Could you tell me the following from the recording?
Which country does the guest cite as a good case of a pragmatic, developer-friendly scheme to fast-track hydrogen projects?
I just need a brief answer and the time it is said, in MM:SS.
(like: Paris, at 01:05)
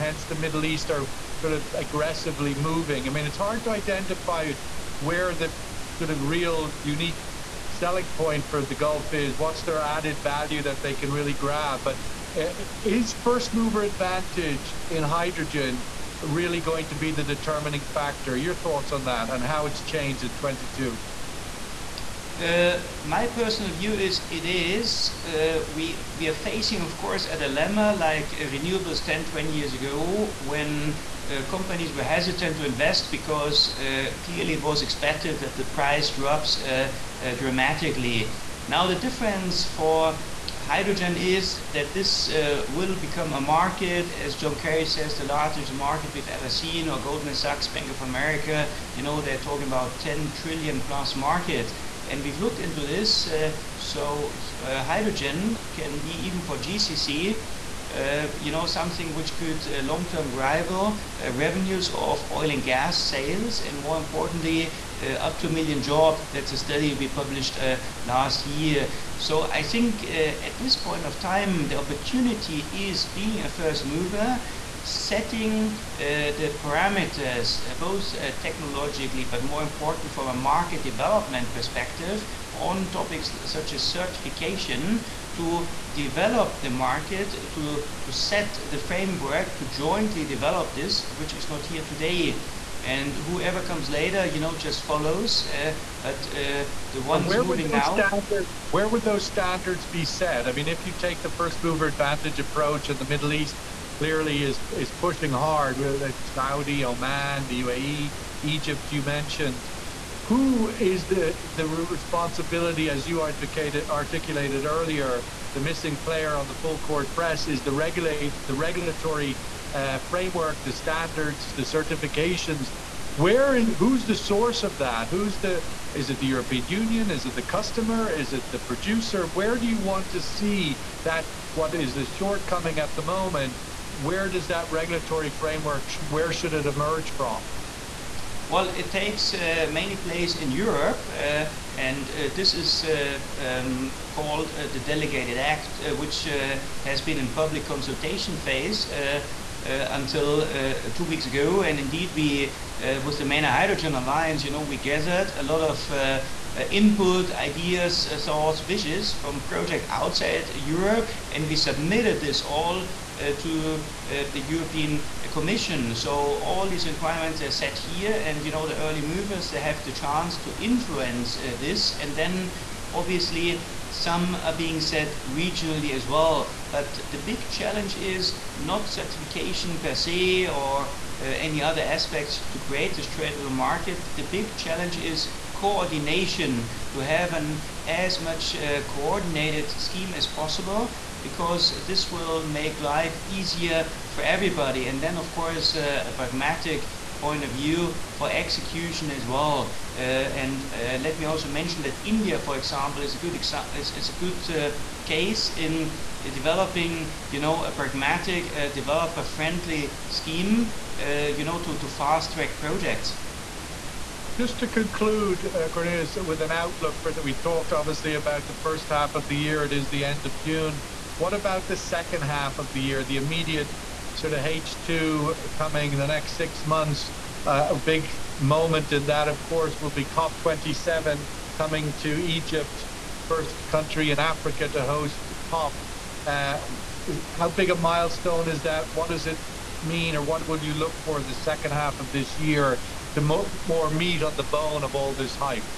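India, at 03:22.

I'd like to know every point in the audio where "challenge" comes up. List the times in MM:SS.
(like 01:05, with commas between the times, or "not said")
02:57, 03:04.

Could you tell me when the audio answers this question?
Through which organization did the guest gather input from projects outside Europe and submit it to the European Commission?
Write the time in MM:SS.
02:33.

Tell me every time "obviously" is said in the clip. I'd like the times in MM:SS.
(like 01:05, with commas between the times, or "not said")
02:52, 03:37.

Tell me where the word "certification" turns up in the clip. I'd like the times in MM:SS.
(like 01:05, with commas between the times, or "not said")
01:23, 02:01, 02:58.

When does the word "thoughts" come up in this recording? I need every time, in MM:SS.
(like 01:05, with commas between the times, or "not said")
00:18, 02:38.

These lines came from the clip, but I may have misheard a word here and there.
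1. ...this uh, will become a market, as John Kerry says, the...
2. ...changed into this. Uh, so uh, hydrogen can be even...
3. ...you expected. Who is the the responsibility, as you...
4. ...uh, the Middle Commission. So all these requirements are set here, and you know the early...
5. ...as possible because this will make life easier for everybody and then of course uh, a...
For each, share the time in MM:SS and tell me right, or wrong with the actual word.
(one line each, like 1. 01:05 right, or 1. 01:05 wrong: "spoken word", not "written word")
1. 00:41 right
2. 00:52 wrong: "looked", not "changed"
3. 01:48 wrong: "mentioned", not "expected"
4. 02:44 wrong: "European", not "Middle"
5. 03:10 right.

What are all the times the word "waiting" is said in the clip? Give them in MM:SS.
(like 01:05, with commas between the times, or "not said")
not said.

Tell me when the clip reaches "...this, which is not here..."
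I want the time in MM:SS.
01:30.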